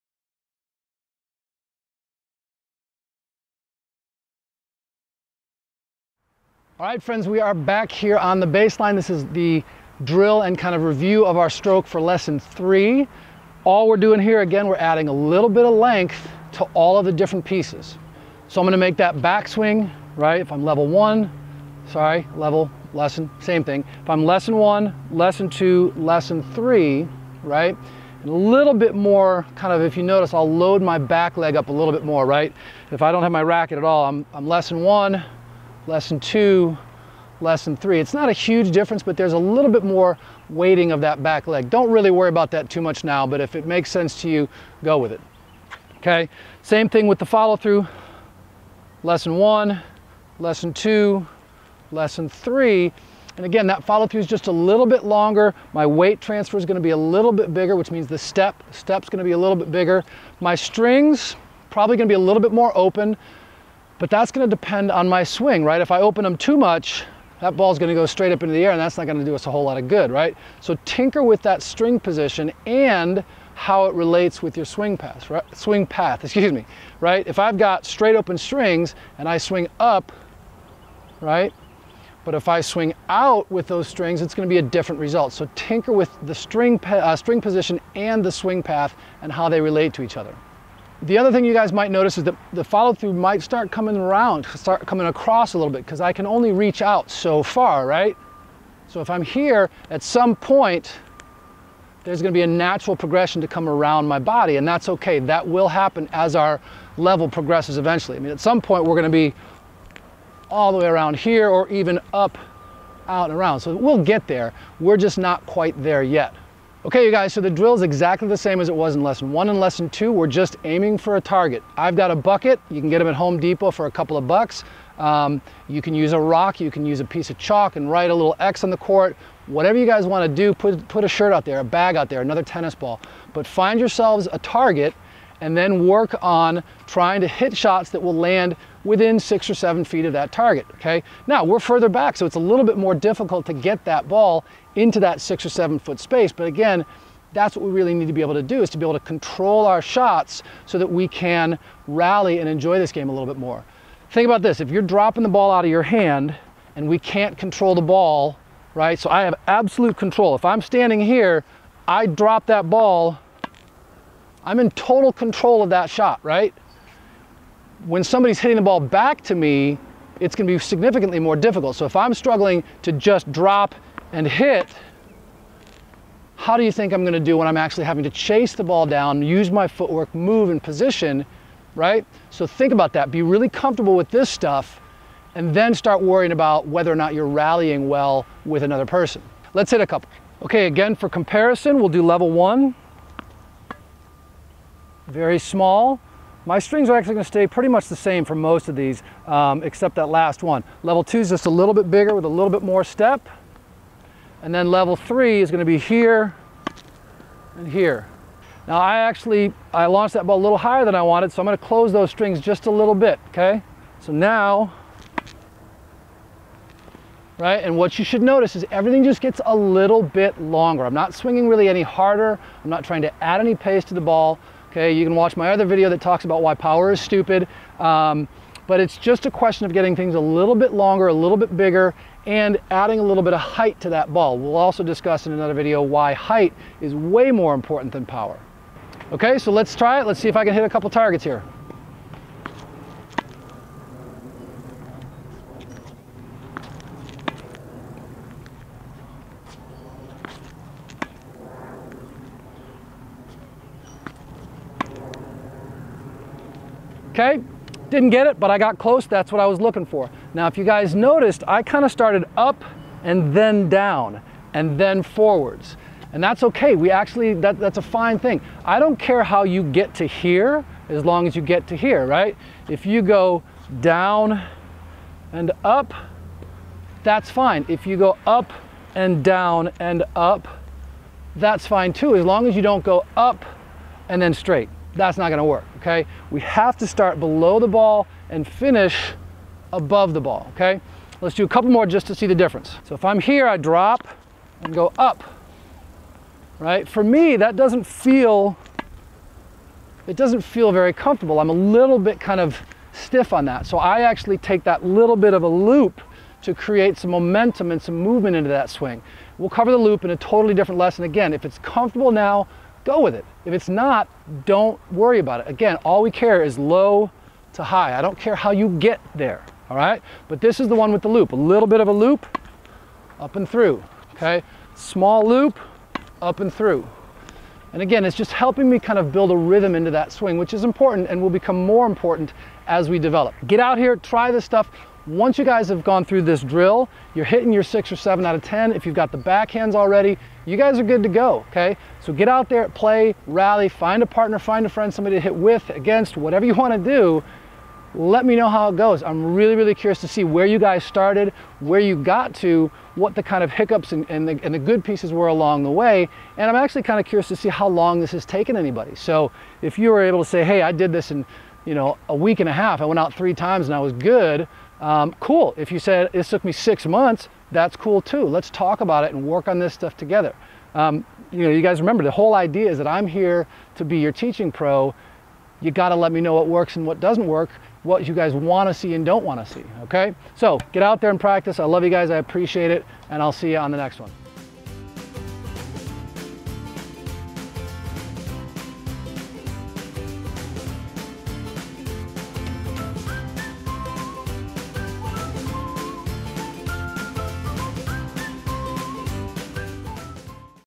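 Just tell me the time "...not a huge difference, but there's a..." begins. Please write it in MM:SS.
00:38.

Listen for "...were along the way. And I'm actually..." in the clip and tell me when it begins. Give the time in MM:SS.
05:55.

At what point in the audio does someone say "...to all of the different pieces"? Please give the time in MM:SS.
00:16.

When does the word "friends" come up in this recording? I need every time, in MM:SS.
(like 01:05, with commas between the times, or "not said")
00:07, 05:44.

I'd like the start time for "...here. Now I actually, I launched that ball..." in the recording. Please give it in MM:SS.
03:27.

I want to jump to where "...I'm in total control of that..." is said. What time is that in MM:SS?
02:44.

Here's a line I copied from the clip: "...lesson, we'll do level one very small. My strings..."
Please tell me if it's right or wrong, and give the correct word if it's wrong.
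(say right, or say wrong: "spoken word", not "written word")
wrong: "comparison", not "lesson".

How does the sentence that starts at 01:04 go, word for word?
But that's gonna depend on my swing, right?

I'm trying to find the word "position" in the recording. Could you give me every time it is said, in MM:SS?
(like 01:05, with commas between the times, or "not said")
01:11, 01:27, 03:00.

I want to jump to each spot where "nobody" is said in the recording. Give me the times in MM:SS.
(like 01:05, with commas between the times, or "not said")
not said.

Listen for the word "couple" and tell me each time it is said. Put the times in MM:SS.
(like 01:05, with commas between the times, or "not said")
02:03, 03:09, 04:00, 04:51.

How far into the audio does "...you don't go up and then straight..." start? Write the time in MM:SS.
04:42.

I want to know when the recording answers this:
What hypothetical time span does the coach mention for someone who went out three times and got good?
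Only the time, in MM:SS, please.
06:02.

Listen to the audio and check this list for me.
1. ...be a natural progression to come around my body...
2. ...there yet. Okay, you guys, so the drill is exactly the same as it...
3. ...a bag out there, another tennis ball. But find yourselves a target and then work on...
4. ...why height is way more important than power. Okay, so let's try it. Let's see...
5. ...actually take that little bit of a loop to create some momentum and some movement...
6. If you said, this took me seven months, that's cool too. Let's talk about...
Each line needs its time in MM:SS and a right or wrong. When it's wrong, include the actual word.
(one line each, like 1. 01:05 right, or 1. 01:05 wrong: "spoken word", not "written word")
1. 01:42 right
2. 01:55 right
3. 02:11 right
4. 03:55 right
5. 05:04 right
6. 06:05 wrong: "six", not "seven".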